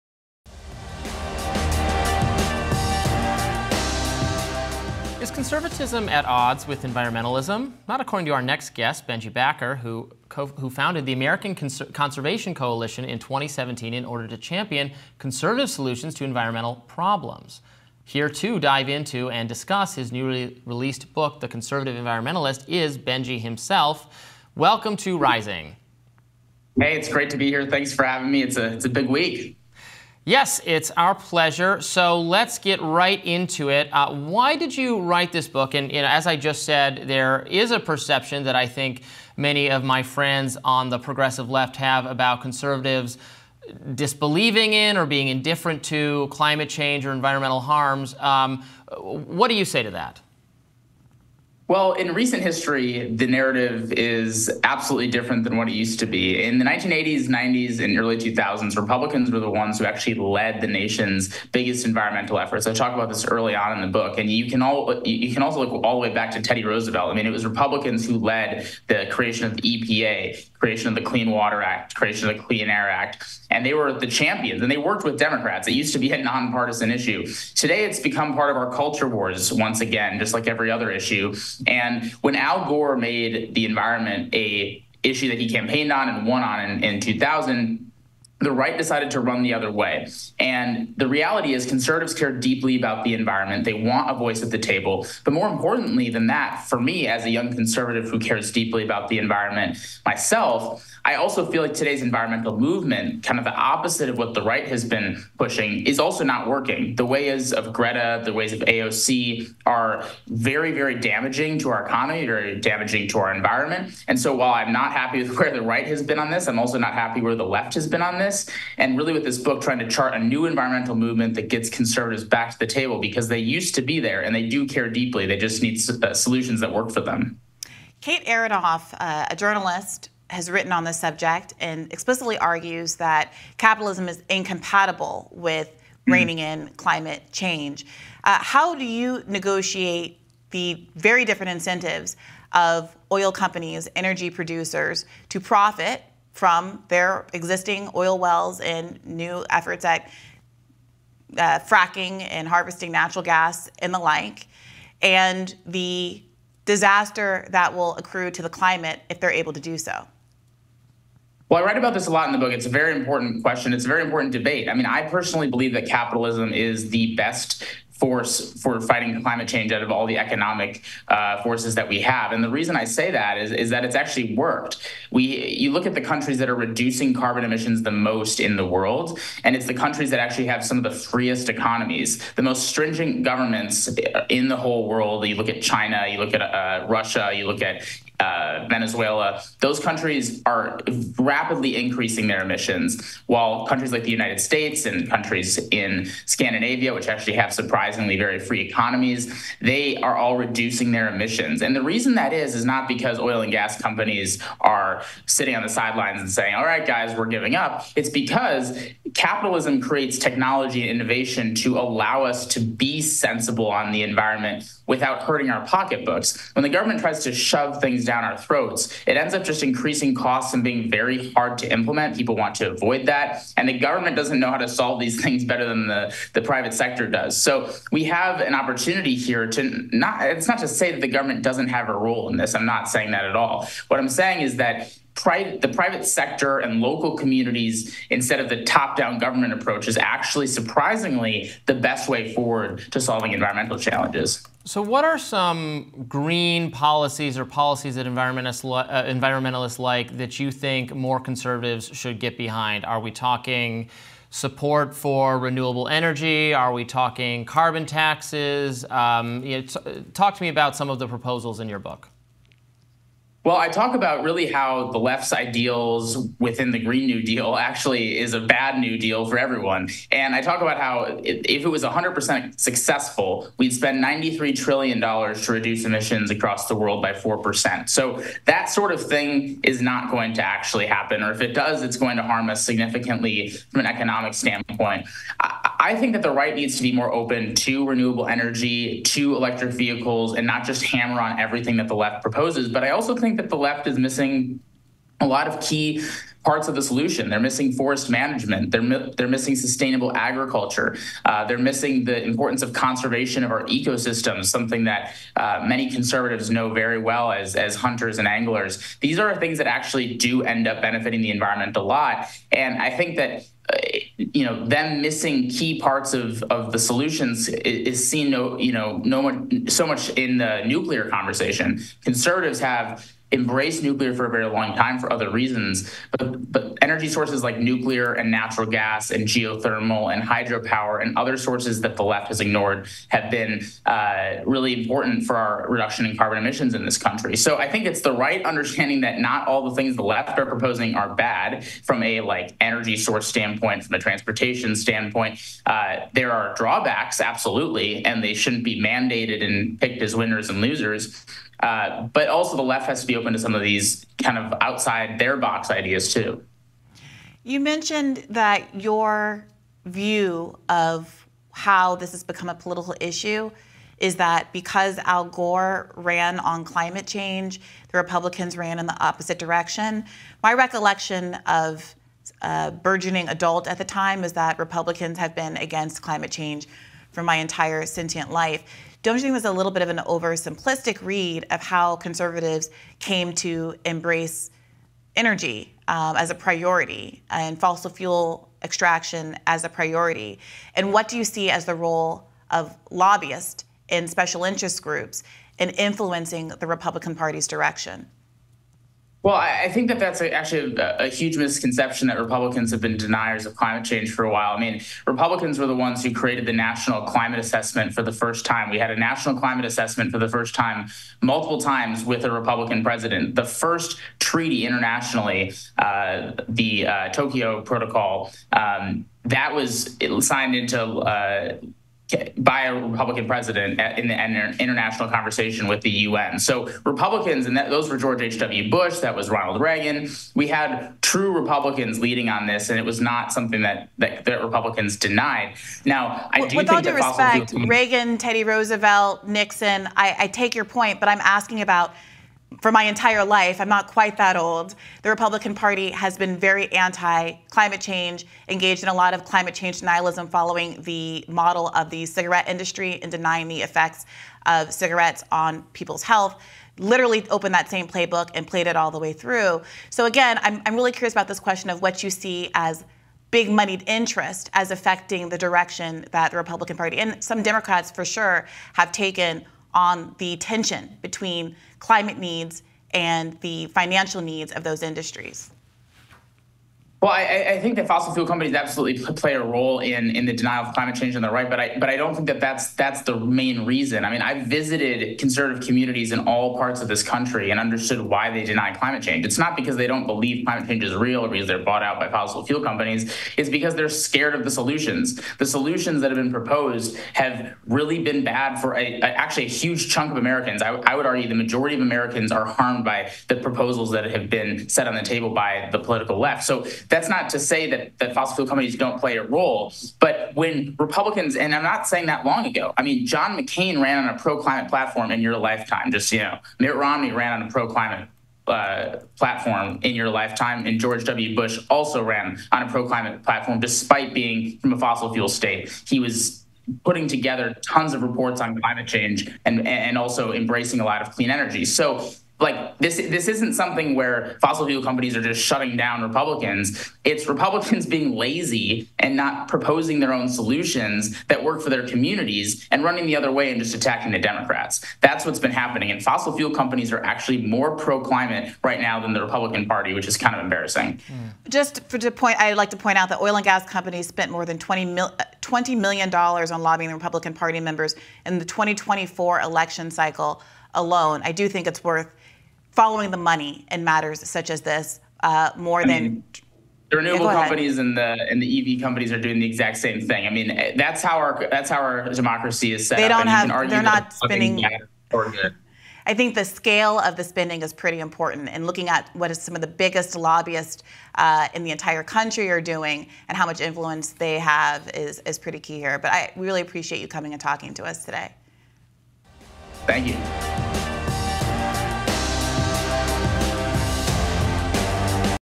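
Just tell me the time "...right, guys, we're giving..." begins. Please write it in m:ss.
3:26.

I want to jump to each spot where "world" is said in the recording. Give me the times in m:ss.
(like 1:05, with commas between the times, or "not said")
2:58, 3:04, 4:36.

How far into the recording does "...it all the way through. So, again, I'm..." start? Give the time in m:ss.
7:38.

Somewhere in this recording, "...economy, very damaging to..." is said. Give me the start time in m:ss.
1:51.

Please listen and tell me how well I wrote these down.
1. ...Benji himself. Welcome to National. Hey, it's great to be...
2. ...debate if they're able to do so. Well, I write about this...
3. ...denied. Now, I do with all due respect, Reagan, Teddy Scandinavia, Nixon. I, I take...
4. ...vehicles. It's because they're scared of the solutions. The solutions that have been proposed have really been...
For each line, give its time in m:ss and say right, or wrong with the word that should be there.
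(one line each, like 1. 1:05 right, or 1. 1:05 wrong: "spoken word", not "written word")
1. 0:22 wrong: "Rising", not "National"
2. 2:38 wrong: "climate", not "debate"
3. 7:14 wrong: "Roosevelt", not "Scandinavia"
4. 8:12 wrong: "companies", not "vehicles".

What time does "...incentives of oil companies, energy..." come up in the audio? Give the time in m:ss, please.
2:21.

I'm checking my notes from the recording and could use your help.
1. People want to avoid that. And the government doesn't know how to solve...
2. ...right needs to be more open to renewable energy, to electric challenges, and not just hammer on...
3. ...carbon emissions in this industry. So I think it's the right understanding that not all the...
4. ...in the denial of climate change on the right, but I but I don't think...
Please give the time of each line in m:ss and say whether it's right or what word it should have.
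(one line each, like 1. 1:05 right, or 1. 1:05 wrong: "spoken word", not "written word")
1. 3:42 right
2. 4:46 wrong: "vehicles", not "challenges"
3. 5:36 wrong: "country", not "industry"
4. 8:00 right.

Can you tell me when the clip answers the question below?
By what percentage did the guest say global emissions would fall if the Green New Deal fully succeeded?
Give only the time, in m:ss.
4:37.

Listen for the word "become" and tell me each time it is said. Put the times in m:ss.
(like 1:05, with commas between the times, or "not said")
1:17, 6:02.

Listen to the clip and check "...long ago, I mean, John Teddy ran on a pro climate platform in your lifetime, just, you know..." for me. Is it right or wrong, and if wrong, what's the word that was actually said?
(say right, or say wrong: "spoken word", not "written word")
wrong: "McCain", not "Teddy".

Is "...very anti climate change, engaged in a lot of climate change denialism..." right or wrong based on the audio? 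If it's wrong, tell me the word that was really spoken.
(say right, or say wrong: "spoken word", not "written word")
right.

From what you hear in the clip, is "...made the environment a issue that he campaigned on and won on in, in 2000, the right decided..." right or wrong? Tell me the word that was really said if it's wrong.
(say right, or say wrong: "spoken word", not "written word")
right.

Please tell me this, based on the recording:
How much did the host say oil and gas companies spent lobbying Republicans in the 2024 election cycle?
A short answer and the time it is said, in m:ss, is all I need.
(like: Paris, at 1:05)
$20 million, at 9:15.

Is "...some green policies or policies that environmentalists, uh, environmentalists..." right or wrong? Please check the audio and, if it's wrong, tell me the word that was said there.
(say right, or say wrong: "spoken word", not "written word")
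right.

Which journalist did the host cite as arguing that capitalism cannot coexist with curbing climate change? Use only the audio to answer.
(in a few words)
Kate Aronoff.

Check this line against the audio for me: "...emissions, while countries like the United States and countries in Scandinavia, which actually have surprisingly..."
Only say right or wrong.
right.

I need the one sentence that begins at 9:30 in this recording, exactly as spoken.
I mean, eh, that's how our that's how our democracy is set they don't up.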